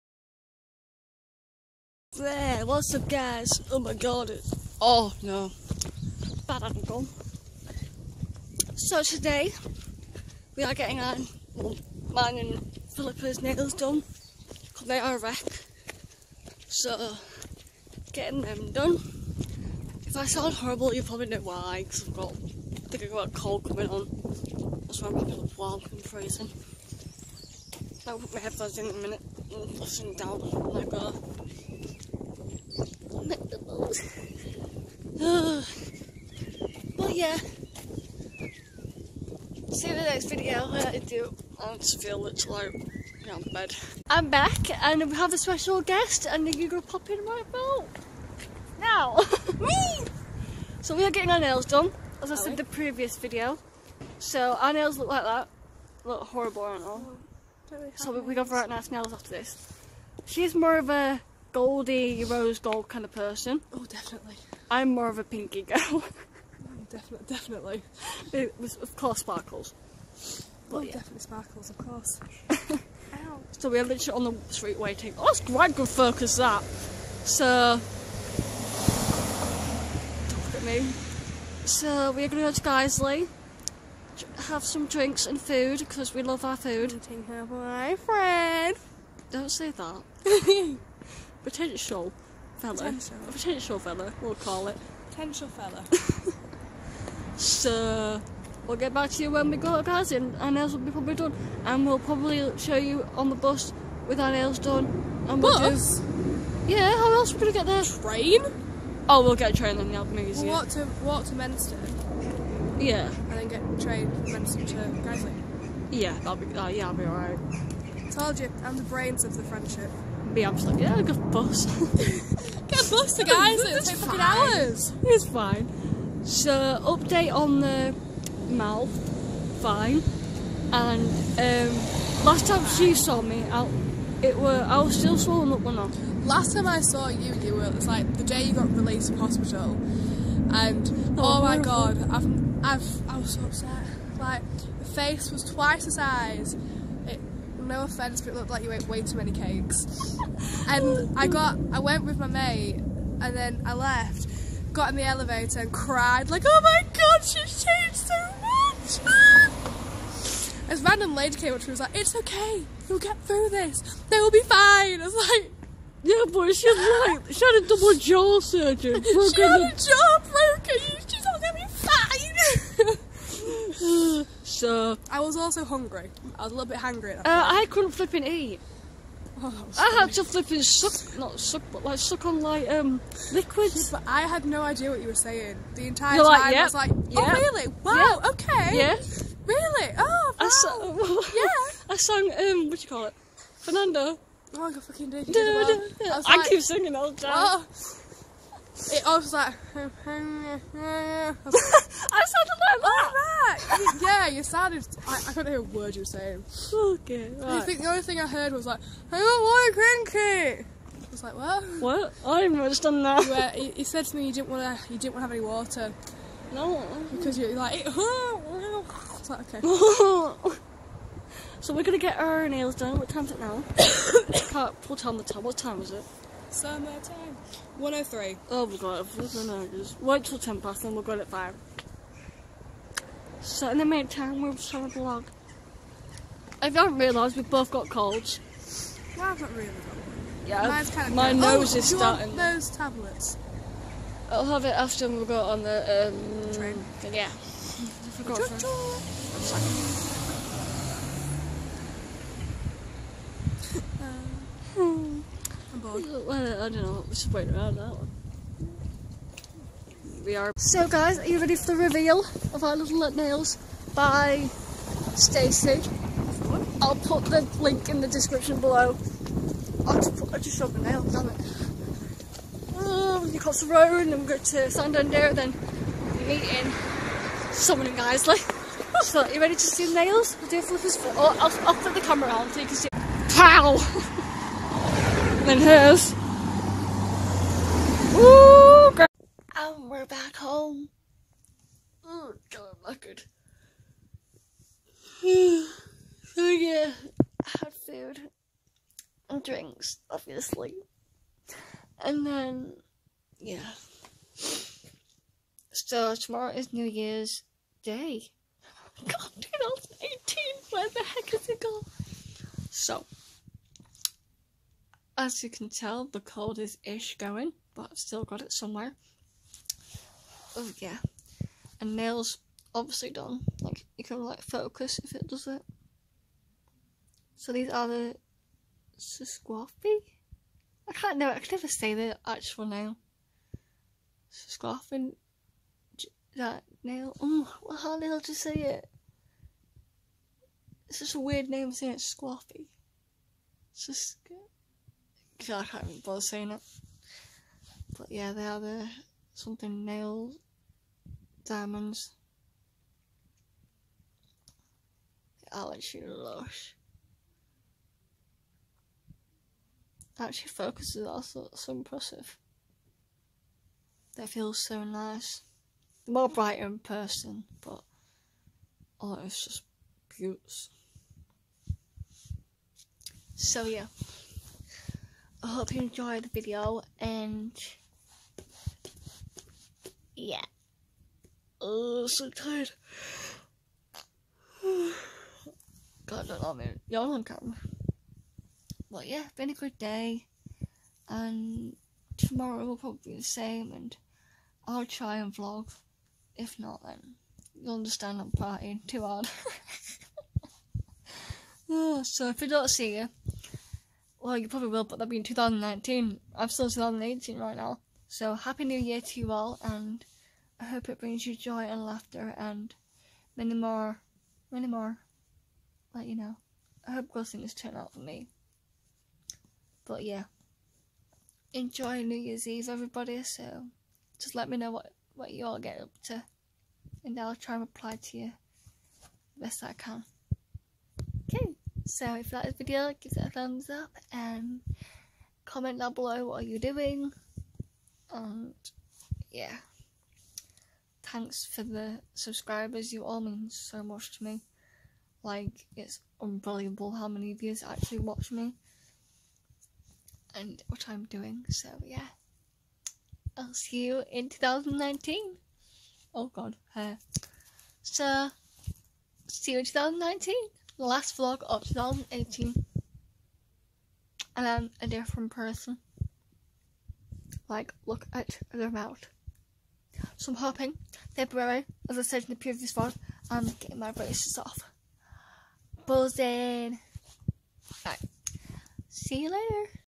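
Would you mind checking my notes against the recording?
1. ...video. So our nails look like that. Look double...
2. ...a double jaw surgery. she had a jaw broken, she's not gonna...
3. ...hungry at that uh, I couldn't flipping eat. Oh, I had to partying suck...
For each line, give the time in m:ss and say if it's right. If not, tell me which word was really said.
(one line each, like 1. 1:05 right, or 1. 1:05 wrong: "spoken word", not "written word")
1. 0:53 wrong: "horrible", not "double"
2. 2:47 right
3. 2:56 wrong: "flipping", not "partying".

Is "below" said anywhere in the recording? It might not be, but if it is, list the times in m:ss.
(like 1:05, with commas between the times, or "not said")
4:28, 7:15.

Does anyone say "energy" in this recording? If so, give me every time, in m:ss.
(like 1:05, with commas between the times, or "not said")
not said.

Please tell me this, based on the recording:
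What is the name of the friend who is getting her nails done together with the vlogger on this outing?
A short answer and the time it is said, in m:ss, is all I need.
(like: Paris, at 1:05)
Philippa, at 0:12.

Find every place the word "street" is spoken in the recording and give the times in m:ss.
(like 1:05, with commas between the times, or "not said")
1:14.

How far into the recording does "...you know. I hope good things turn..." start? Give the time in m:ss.
6:56.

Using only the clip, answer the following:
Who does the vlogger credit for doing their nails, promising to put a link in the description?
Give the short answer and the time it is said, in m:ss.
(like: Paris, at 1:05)
Stacy, at 4:25.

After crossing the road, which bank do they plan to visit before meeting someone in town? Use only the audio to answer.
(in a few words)
Santander.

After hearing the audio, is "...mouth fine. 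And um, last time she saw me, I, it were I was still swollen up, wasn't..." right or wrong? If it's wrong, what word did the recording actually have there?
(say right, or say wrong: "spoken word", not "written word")
right.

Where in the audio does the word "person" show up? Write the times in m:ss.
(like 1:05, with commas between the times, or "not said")
1:03, 6:06, 7:45.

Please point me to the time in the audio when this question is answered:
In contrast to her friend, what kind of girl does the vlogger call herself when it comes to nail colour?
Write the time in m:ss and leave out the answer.
1:05.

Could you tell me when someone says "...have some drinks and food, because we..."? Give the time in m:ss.
1:24.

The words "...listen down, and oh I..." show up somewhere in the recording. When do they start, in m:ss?
0:29.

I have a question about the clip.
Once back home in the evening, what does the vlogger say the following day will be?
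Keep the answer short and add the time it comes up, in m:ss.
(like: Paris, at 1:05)
New Year's Day, at 5:06.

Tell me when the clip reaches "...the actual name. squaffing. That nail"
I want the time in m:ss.
5:31.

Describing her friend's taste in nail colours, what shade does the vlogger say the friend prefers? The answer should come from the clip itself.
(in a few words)
Rose gold.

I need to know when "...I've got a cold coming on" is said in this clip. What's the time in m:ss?
0:23.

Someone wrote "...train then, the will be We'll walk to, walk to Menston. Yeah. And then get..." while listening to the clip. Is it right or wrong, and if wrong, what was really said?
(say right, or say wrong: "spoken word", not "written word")
right.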